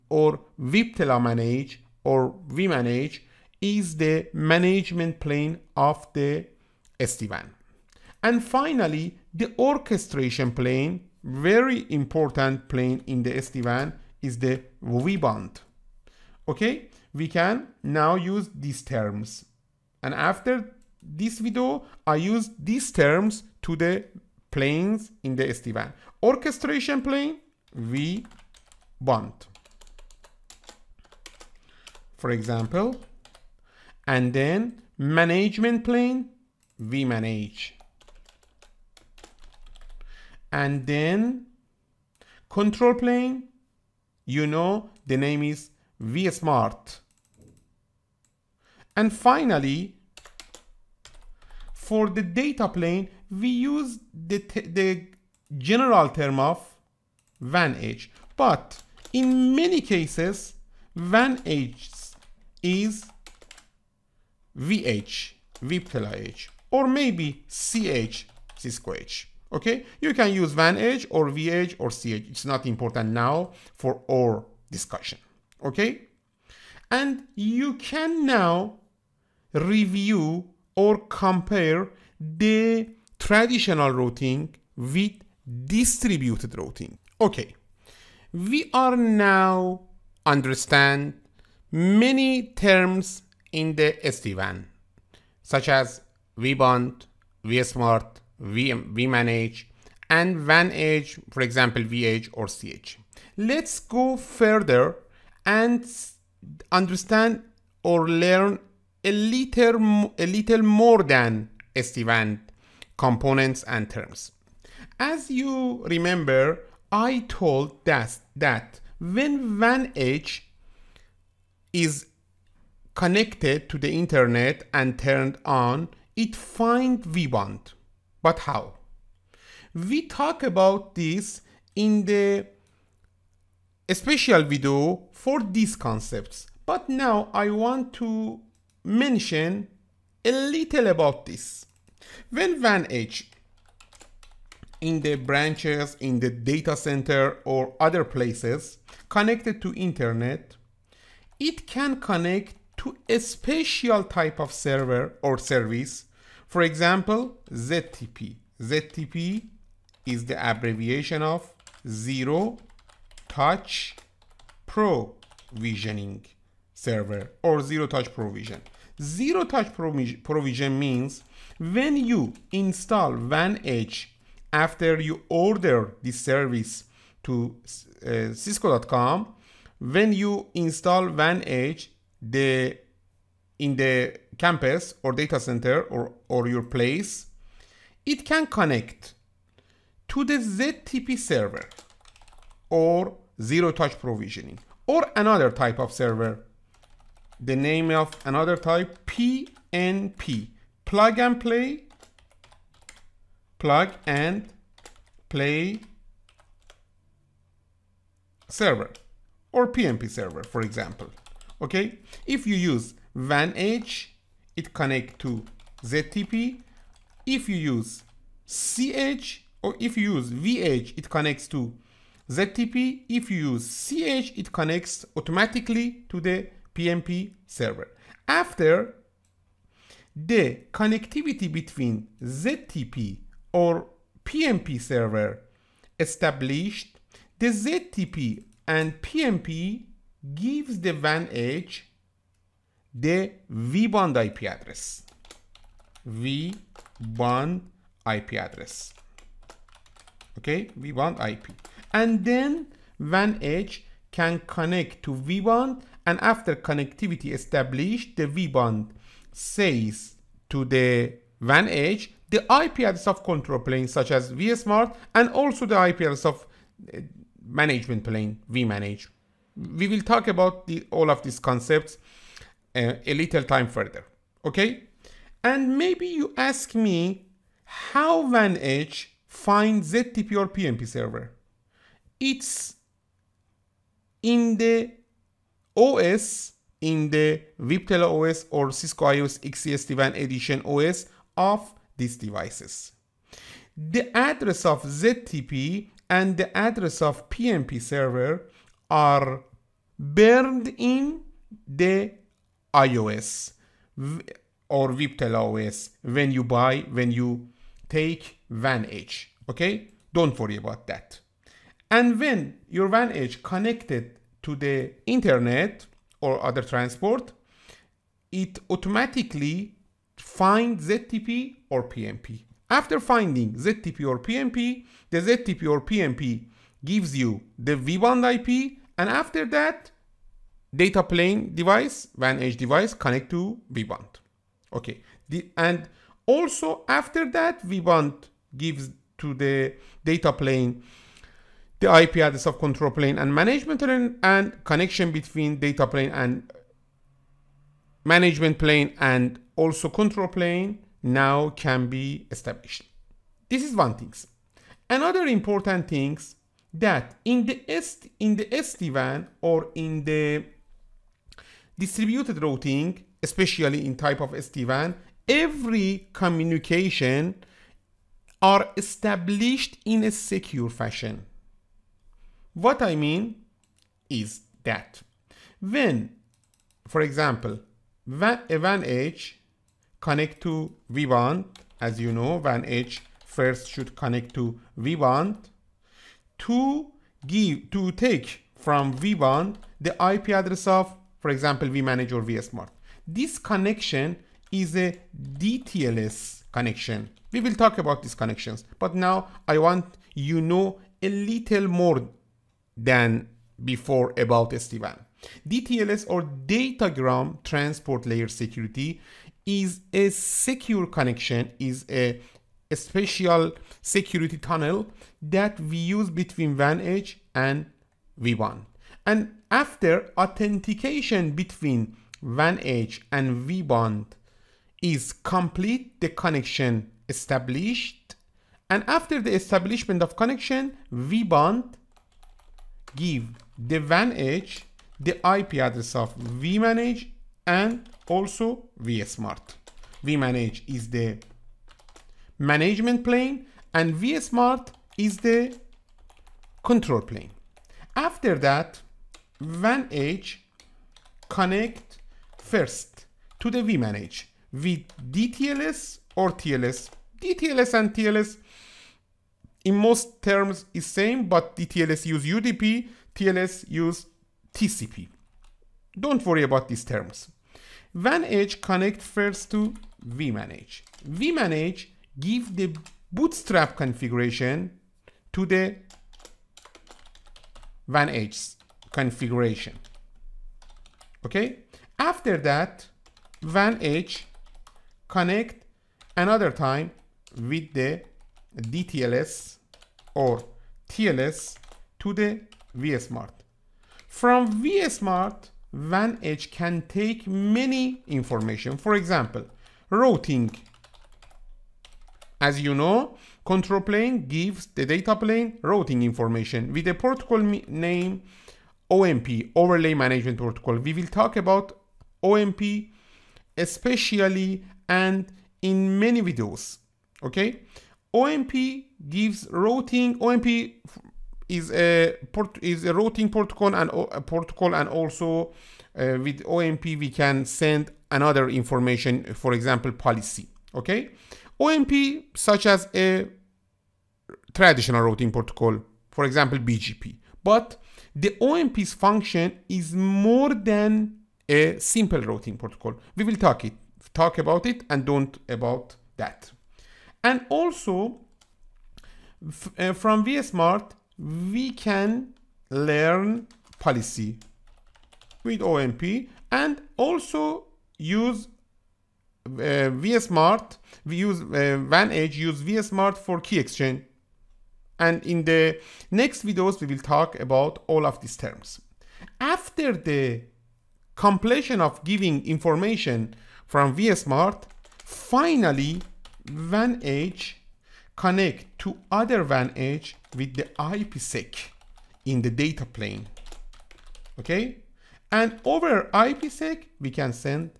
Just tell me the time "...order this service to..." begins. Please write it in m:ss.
2:55.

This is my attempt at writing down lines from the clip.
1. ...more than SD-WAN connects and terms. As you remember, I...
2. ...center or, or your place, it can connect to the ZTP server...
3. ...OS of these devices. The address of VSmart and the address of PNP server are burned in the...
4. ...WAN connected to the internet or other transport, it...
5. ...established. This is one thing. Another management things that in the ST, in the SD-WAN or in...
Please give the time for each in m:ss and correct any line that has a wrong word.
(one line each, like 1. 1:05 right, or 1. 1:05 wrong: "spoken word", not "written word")
1. 1:50 wrong: "components", not "connects"
2. 3:05 right
3. 4:50 wrong: "ZTP", not "VSmart"
4. 5:12 right
5. 5:52 wrong: "important", not "management".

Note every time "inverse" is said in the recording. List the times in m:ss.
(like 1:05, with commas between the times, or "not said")
not said.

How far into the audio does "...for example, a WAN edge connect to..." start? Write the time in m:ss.
6:16.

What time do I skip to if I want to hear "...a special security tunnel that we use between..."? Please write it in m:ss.
6:52.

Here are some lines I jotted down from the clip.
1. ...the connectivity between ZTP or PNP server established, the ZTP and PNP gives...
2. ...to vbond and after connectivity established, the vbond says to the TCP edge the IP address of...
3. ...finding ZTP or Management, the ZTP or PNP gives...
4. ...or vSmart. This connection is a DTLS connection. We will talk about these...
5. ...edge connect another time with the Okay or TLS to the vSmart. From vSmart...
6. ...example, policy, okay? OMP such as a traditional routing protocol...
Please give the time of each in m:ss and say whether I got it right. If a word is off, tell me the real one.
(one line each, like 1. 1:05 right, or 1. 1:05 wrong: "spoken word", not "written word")
1. 3:50 right
2. 4:15 wrong: "WAN", not "TCP"
3. 5:22 wrong: "PNP", not "Management"
4. 6:32 right
5. 8:03 wrong: "DTLS", not "Okay"
6. 8:49 right.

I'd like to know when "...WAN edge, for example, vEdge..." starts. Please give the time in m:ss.
1:40.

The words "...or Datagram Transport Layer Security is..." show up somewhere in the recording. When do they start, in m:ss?
6:46.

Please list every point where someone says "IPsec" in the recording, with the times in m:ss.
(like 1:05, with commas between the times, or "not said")
9:40, 9:46.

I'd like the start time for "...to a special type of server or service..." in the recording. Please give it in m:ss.
2:32.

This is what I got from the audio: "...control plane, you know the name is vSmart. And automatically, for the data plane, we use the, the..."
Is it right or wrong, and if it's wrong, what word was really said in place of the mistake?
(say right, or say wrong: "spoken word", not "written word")
wrong: "finally", not "automatically".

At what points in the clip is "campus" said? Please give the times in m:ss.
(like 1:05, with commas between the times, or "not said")
3:04.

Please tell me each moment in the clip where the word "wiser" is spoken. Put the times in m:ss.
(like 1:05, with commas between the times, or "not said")
not said.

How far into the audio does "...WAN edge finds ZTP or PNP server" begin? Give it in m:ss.
4:38.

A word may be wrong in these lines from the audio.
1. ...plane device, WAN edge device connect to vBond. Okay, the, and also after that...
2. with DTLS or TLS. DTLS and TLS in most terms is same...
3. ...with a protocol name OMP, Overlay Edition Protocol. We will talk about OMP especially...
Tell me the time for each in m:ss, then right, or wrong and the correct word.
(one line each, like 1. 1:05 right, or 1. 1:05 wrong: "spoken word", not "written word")
1. 5:31 right
2. 7:34 right
3. 8:26 wrong: "Management", not "Edition".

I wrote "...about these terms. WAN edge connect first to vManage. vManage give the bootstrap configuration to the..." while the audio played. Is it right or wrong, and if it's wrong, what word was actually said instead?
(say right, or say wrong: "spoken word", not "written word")
right.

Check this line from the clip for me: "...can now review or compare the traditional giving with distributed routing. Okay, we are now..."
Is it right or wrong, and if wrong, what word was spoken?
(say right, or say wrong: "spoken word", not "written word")
wrong: "routing", not "giving".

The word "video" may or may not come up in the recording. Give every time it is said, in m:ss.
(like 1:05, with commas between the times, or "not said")
0:21, 2:14, 8:36, 9:26.